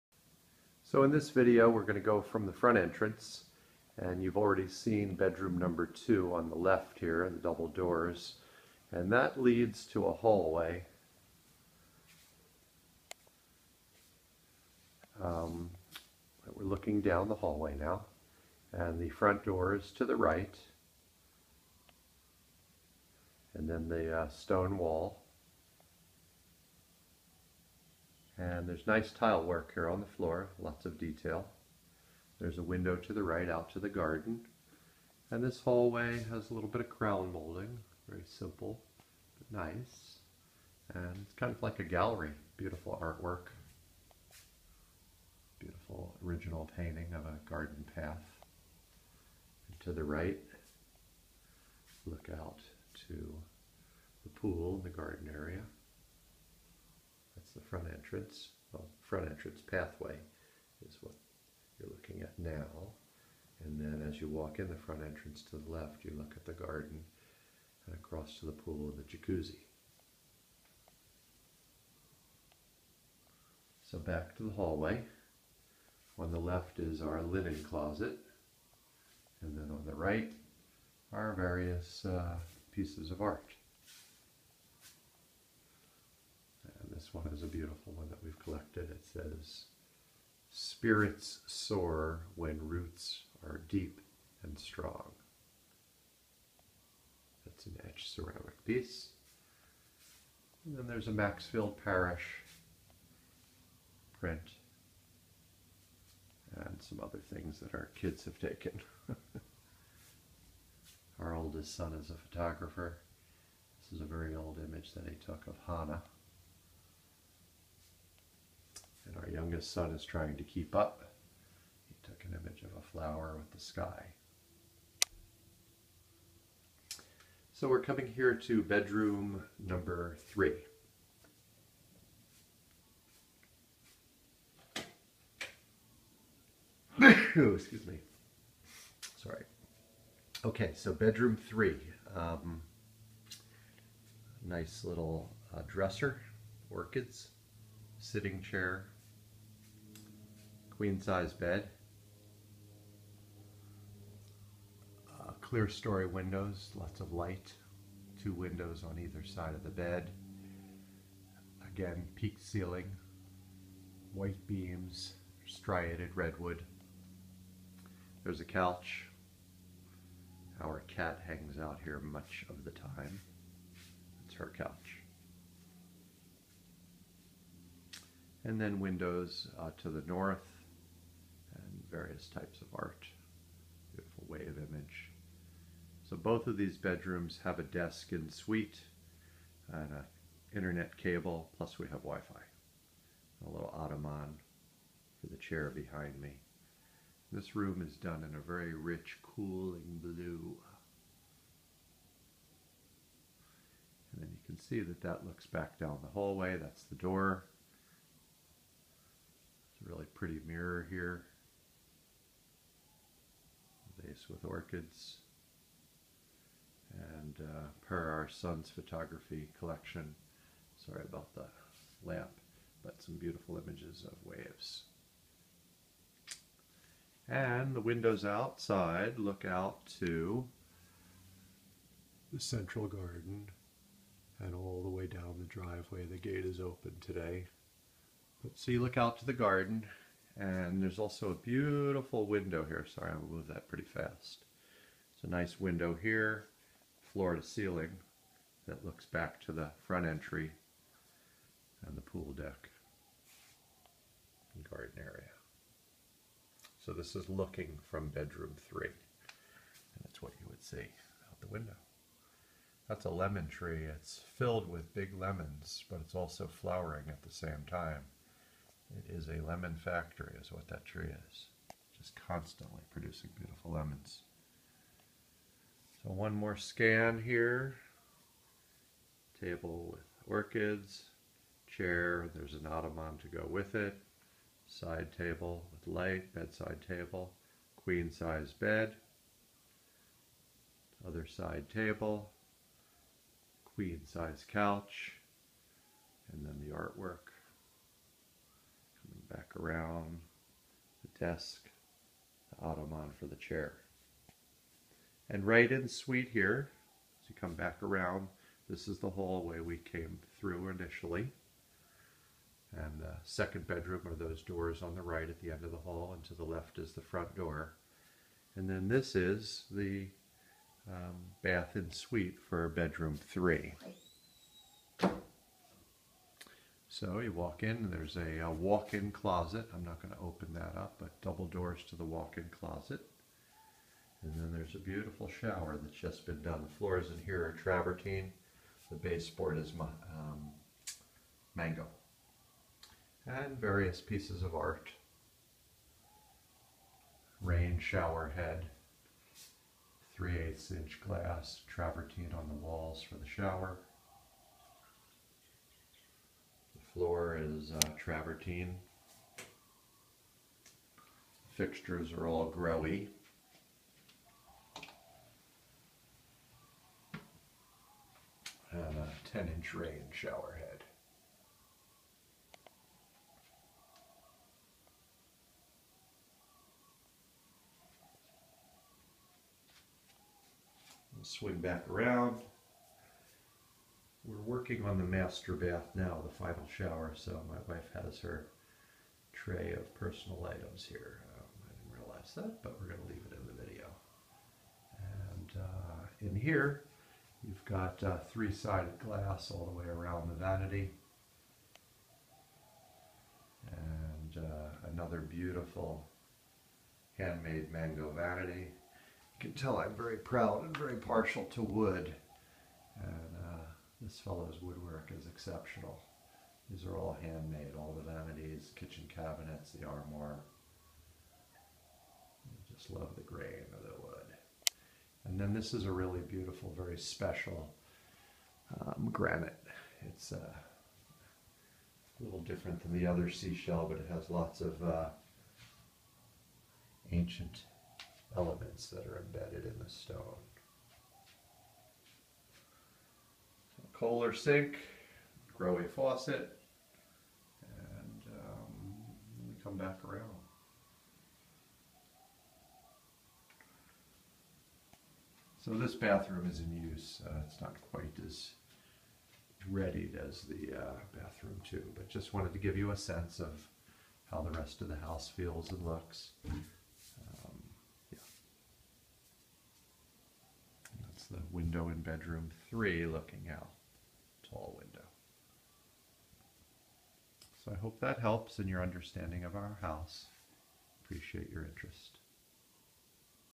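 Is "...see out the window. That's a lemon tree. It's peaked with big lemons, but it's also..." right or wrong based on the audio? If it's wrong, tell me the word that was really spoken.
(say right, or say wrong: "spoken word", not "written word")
wrong: "filled", not "peaked".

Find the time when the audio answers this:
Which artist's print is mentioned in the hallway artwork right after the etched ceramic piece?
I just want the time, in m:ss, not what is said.
1:41.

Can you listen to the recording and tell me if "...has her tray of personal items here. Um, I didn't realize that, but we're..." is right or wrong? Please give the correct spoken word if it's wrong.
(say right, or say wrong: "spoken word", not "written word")
right.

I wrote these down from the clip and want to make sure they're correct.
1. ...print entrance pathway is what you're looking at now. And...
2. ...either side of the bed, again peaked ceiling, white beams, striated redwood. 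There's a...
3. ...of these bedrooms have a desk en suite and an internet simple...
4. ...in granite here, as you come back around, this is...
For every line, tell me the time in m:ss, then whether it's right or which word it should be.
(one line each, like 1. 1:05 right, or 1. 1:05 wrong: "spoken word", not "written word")
1. 0:59 wrong: "front", not "print"
2. 2:38 right
3. 3:06 wrong: "cable", not "simple"
4. 5:05 wrong: "suite", not "granite".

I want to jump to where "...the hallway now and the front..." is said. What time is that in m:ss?
0:17.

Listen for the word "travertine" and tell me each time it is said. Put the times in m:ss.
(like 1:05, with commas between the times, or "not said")
5:37, 5:51, 5:57.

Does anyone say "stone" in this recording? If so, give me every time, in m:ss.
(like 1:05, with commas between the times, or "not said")
0:24, 7:19.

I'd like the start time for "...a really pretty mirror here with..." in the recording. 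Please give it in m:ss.
3:29.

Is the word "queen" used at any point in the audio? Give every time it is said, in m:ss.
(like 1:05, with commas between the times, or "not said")
2:30, 4:47, 4:53.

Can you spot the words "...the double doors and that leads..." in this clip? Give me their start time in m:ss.
0:07.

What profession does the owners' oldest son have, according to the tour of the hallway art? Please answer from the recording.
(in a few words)
Photographer.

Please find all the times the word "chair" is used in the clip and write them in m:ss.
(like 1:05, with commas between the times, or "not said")
2:28, 3:15, 4:41, 5:03.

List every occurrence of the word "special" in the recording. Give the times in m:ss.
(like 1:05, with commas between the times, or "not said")
7:06.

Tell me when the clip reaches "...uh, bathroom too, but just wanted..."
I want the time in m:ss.
7:40.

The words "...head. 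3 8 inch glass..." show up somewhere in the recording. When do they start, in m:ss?
5:48.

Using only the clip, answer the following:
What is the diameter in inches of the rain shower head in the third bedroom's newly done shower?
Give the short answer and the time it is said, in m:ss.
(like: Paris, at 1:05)
10 inch, at 6:09.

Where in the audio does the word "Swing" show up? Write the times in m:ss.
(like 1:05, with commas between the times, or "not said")
6:21.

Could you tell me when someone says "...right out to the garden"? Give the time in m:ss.
0:33.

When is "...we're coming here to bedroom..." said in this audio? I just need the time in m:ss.
2:07.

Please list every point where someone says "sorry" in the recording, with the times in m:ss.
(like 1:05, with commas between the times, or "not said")
2:19, 3:40, 4:02.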